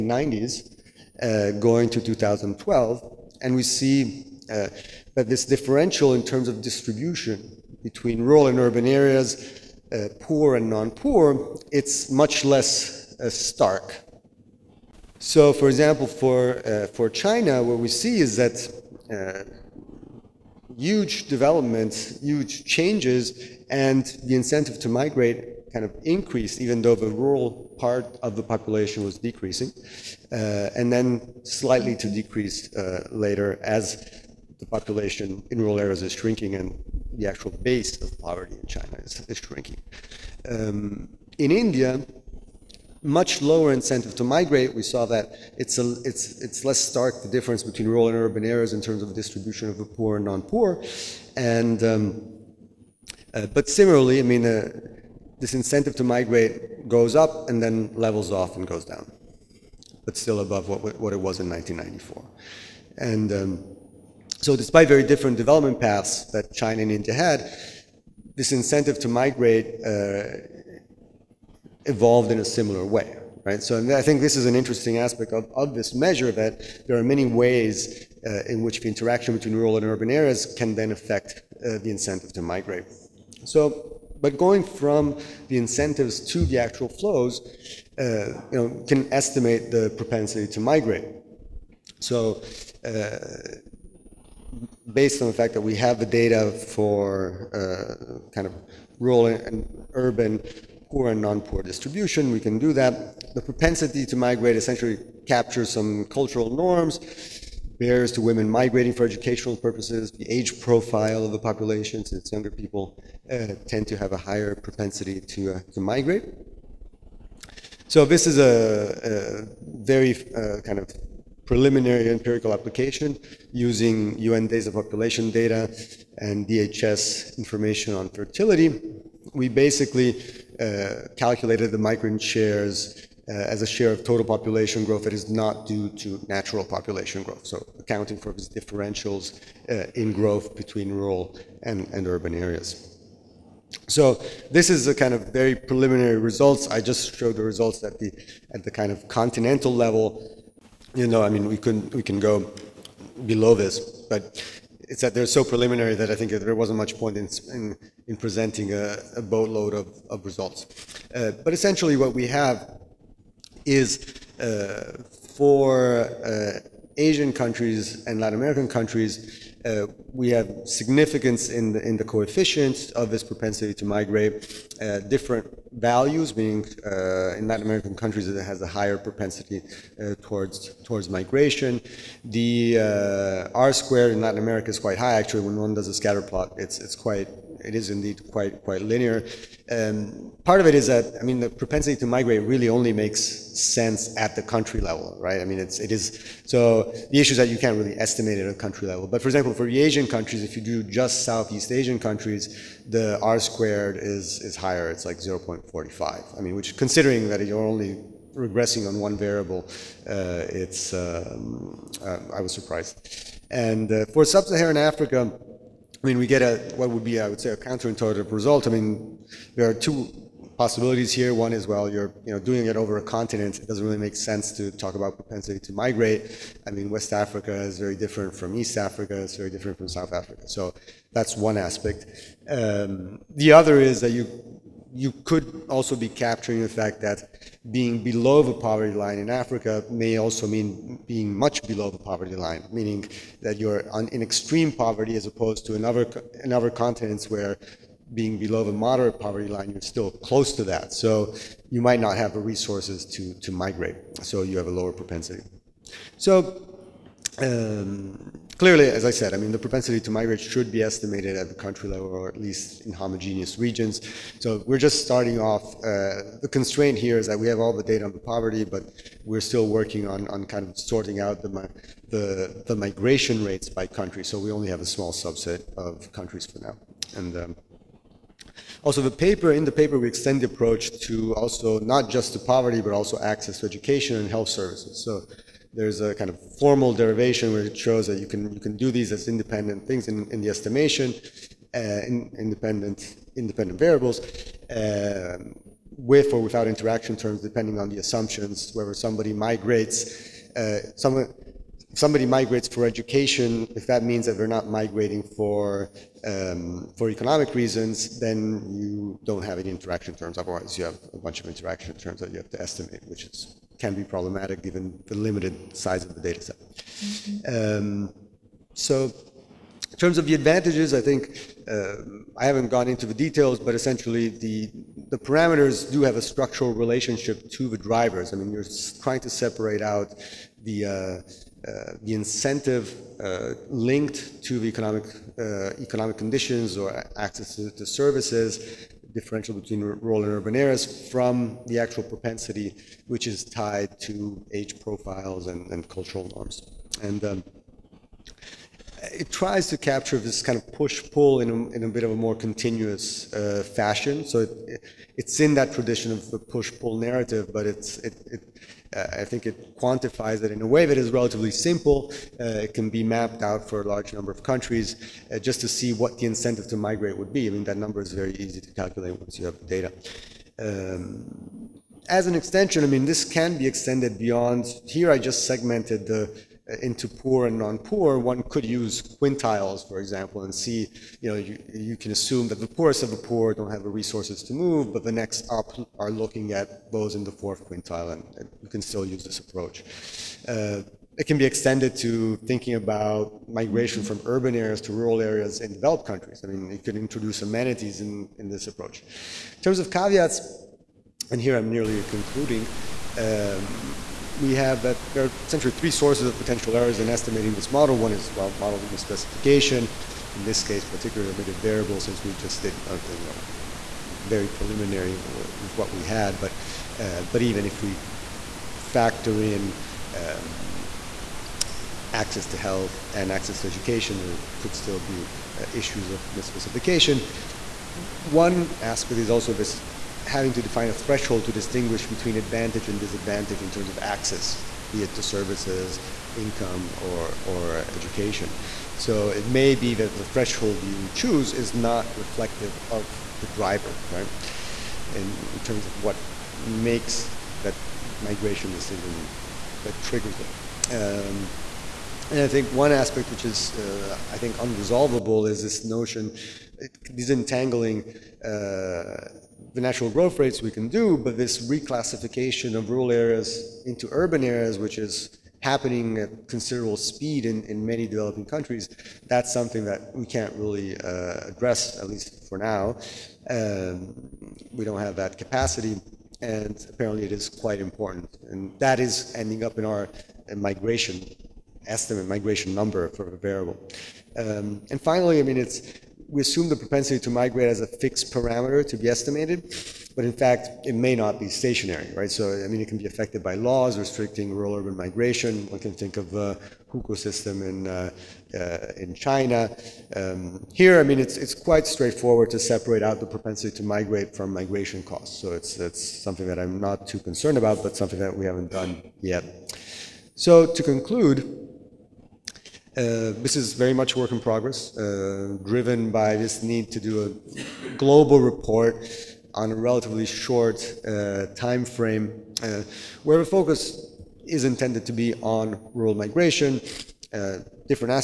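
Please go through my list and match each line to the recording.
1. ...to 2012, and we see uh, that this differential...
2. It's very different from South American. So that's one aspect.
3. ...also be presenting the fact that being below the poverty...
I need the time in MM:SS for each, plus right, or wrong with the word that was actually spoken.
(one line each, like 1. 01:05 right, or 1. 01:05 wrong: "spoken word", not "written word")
1. 00:01 right
2. 03:49 wrong: "Africa", not "American"
3. 03:55 wrong: "capturing", not "presenting".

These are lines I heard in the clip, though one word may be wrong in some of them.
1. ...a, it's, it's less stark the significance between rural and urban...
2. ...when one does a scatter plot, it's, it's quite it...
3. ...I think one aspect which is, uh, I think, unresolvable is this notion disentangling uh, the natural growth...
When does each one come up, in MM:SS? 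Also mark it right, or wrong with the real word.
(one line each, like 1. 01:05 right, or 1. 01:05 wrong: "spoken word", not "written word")
1. 00:45 wrong: "difference", not "significance"
2. 03:05 right
3. 07:32 right.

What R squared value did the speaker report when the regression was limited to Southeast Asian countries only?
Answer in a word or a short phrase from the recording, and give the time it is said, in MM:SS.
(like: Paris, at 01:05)
0.45, at 03:25.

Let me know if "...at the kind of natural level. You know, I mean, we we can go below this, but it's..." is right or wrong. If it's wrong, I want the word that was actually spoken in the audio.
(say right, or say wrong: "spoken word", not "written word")
wrong: "continental", not "natural".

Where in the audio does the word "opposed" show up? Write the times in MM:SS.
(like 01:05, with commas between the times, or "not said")
04:05.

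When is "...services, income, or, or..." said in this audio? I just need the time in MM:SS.
07:15.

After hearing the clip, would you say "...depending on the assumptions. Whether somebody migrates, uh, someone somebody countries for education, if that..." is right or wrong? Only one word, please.
wrong.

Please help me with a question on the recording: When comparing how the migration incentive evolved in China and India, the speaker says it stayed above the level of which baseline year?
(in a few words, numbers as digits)
1994.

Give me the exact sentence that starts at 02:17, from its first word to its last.
So accounting for these differentials uh, in growth between rural and, and urban areas.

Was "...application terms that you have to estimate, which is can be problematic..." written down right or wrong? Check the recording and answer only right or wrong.
wrong.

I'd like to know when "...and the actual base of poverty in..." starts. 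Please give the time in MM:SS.
00:36.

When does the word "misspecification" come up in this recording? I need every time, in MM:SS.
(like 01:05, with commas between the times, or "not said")
06:48, 07:06.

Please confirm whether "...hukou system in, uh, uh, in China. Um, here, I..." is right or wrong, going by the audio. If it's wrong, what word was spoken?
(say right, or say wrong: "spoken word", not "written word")
right.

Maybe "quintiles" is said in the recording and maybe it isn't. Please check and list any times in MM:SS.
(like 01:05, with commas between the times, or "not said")
06:19, 06:27.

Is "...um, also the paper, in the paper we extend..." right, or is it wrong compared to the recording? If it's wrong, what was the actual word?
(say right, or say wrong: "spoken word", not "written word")
right.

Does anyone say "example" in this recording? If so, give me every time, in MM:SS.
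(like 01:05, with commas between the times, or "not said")
00:15, 03:19, 06:19.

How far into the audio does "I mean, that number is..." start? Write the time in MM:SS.
06:07.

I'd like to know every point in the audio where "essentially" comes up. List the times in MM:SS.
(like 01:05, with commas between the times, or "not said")
01:44, 02:41, 05:23, 06:45.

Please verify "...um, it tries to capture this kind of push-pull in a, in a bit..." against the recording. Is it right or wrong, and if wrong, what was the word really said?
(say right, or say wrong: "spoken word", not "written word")
right.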